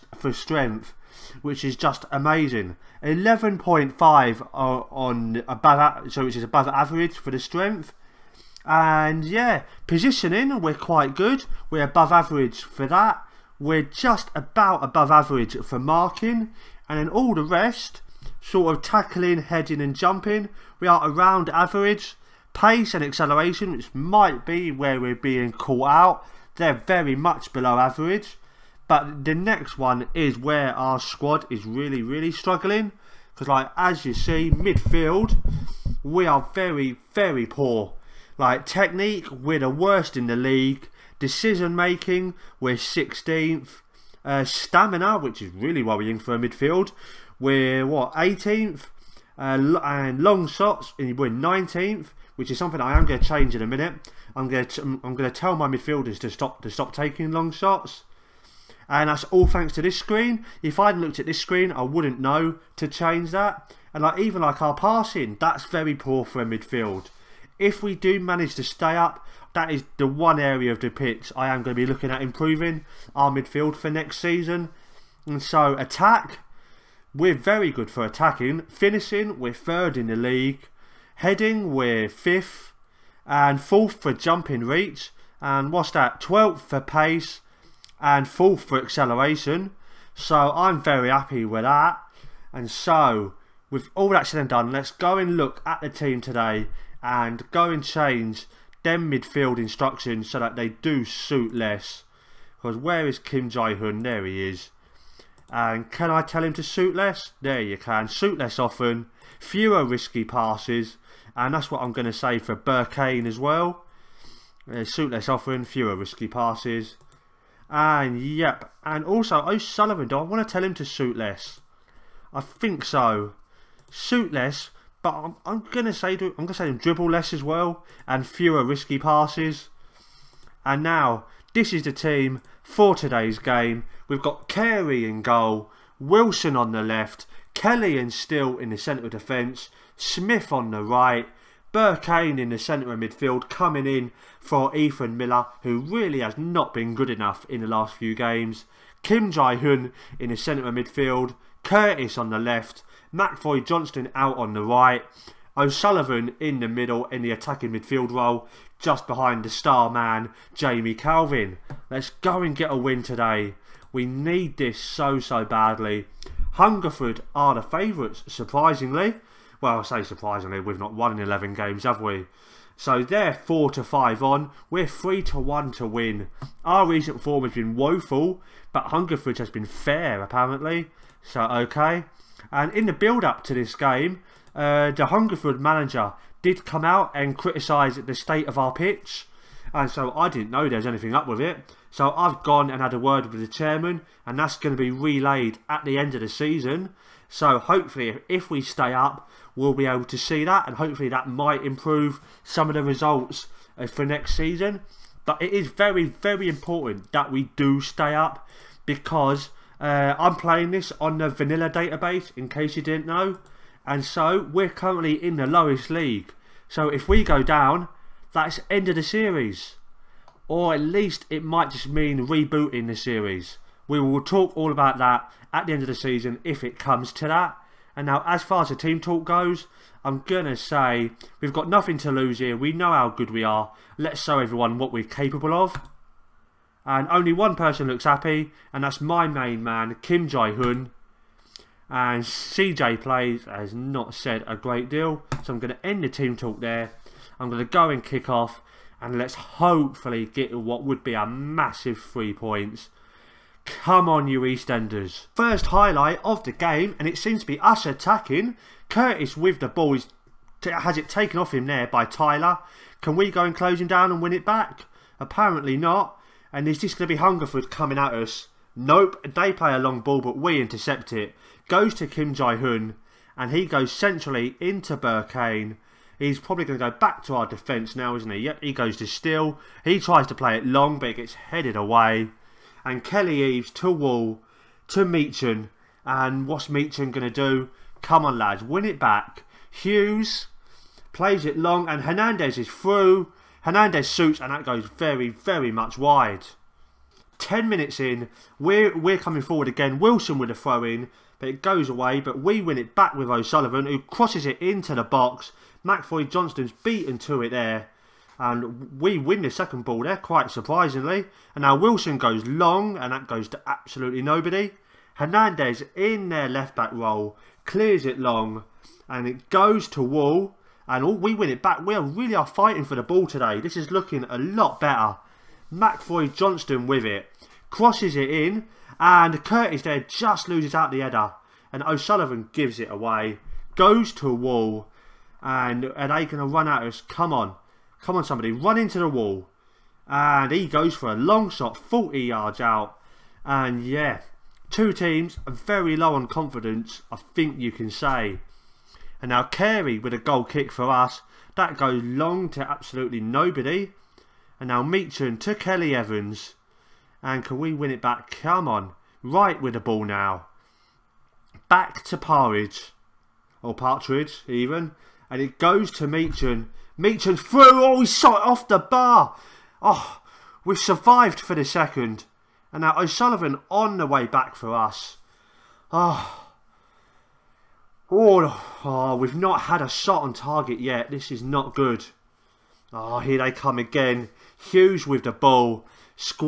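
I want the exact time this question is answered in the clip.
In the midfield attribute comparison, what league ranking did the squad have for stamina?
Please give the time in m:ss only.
0:48.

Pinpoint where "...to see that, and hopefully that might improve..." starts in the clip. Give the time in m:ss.
3:20.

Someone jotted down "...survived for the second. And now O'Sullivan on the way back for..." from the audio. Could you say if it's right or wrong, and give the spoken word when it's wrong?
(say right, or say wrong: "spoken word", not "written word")
right.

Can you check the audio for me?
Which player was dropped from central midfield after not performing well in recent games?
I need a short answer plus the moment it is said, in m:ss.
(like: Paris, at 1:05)
Ethan Miller, at 2:24.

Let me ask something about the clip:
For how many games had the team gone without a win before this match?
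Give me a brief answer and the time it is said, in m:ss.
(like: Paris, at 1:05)
11, at 2:51.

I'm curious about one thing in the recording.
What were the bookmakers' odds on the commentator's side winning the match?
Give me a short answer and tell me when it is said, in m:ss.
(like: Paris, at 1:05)
3 to 1, at 2:54.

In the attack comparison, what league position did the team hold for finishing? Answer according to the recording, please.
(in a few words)
Third.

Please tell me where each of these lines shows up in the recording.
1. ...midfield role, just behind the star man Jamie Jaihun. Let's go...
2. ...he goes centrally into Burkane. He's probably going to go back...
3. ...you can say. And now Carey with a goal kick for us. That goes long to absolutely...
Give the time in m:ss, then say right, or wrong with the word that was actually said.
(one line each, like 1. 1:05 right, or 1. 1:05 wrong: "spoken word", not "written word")
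1. 2:37 wrong: "Calvin", not "Jaihun"
2. 4:33 right
3. 5:47 right.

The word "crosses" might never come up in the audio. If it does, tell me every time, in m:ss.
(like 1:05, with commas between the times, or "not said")
5:03, 5:27.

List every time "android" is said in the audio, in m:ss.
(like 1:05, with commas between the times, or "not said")
not said.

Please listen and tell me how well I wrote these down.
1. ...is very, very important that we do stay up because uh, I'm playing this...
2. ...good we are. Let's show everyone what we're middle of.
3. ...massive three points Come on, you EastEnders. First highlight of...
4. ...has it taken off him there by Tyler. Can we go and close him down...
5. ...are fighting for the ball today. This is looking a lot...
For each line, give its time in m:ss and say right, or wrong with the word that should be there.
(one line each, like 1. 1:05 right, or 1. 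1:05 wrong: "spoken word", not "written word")
1. 3:25 right
2. 3:53 wrong: "capable", not "middle"
3. 4:11 right
4. 4:20 right
5. 5:22 right.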